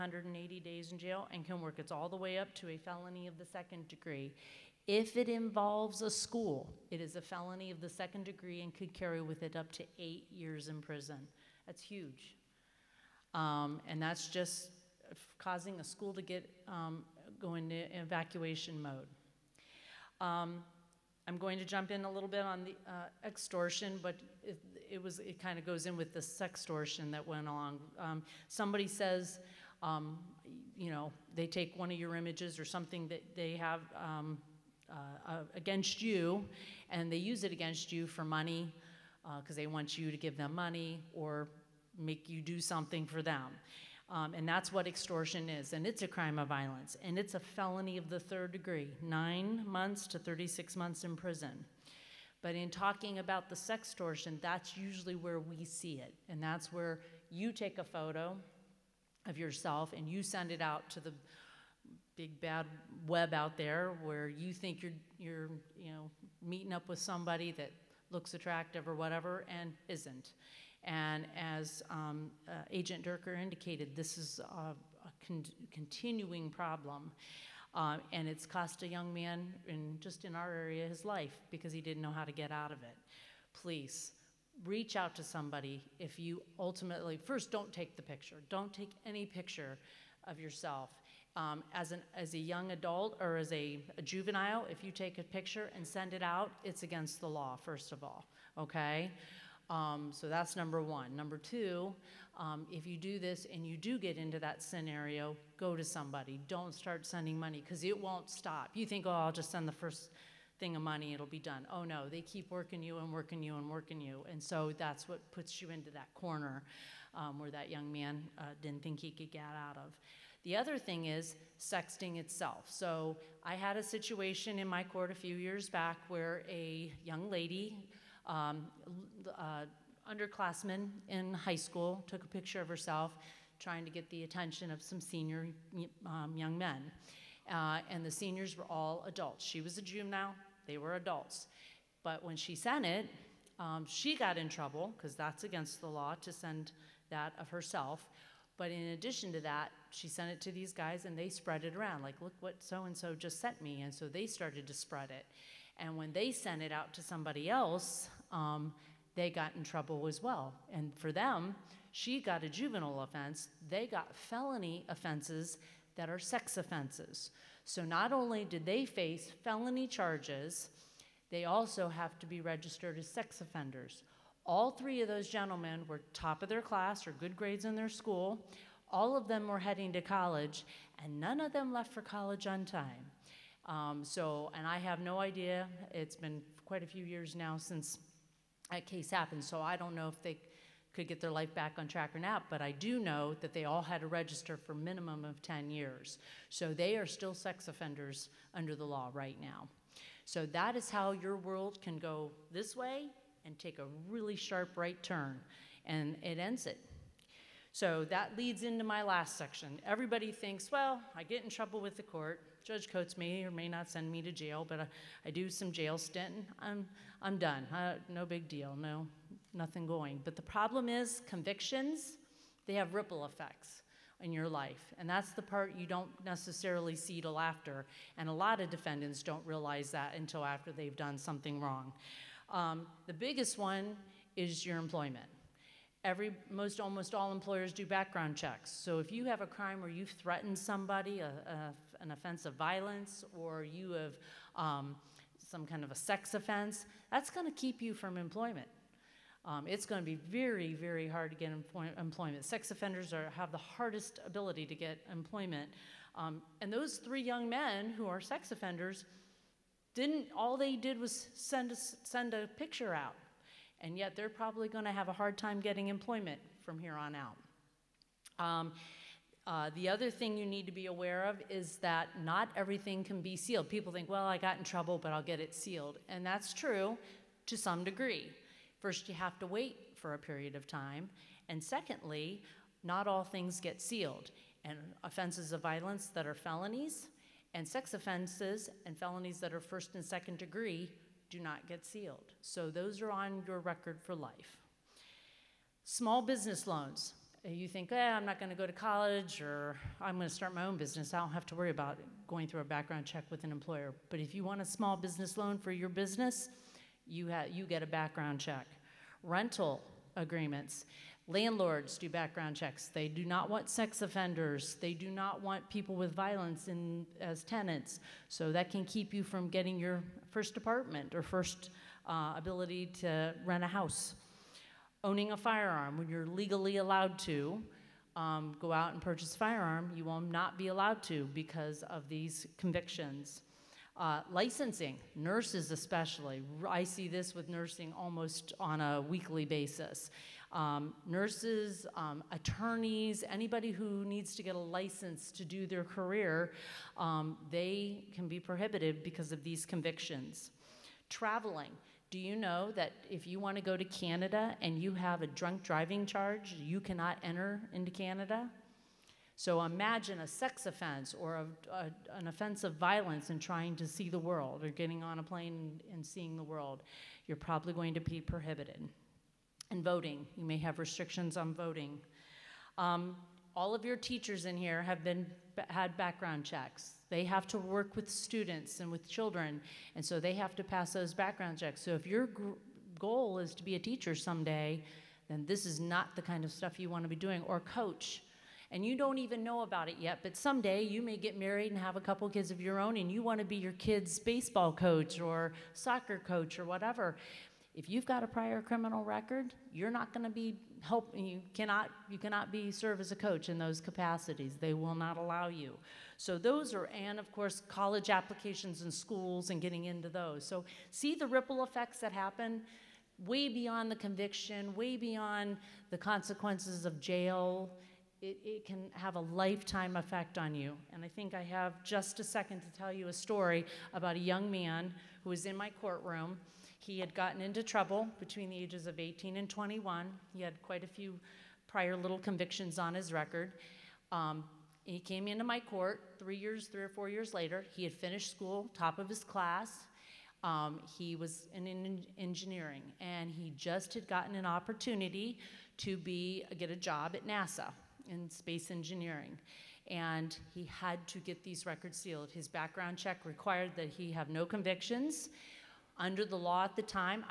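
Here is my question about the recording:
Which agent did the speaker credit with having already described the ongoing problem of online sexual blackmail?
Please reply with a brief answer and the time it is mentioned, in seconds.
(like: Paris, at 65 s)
Agent Durker, at 72 s.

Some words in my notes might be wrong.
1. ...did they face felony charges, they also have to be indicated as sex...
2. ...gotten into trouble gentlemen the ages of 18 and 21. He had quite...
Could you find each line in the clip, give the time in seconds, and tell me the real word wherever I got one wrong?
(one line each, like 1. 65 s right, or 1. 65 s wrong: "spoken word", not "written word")
1. 168 s wrong: "registered", not "indicated"
2. 427 s wrong: "between", not "gentlemen".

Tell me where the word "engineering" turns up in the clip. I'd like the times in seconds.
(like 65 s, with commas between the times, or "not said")
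442 s, 448 s.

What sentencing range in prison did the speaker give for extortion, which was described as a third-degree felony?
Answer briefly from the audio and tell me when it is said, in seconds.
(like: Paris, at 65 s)
9 to 36 months, at 49 s.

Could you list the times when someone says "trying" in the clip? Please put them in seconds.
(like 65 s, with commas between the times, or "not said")
133 s, 363 s.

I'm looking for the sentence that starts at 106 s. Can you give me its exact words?
Don't start sending money because it won't stop.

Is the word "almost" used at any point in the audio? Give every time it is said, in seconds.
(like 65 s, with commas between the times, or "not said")
236 s, 337 s.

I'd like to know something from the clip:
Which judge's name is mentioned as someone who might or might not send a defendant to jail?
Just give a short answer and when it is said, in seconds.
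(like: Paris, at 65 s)
Judge Coates, at 212 s.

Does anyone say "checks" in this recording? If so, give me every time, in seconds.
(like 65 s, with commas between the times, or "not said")
238 s, 303 s, 308 s, 312 s, 376 s, 381 s, 452 s.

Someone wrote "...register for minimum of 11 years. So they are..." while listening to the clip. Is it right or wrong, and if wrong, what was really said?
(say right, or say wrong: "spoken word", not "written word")
wrong: "10", not "11".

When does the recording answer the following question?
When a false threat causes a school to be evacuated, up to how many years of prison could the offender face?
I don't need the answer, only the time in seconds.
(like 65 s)
9 s.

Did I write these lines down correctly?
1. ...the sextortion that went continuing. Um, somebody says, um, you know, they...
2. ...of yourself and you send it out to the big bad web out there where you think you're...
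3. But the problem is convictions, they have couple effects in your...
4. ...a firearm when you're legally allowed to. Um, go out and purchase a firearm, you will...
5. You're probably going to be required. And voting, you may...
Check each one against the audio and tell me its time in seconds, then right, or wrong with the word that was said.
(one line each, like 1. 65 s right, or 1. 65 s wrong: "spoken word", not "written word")
1. 26 s wrong: "along", not "continuing"
2. 59 s right
3. 220 s wrong: "ripple", not "couple"
4. 325 s right
5. 367 s wrong: "prohibited", not "required".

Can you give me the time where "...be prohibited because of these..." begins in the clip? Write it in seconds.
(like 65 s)
348 s.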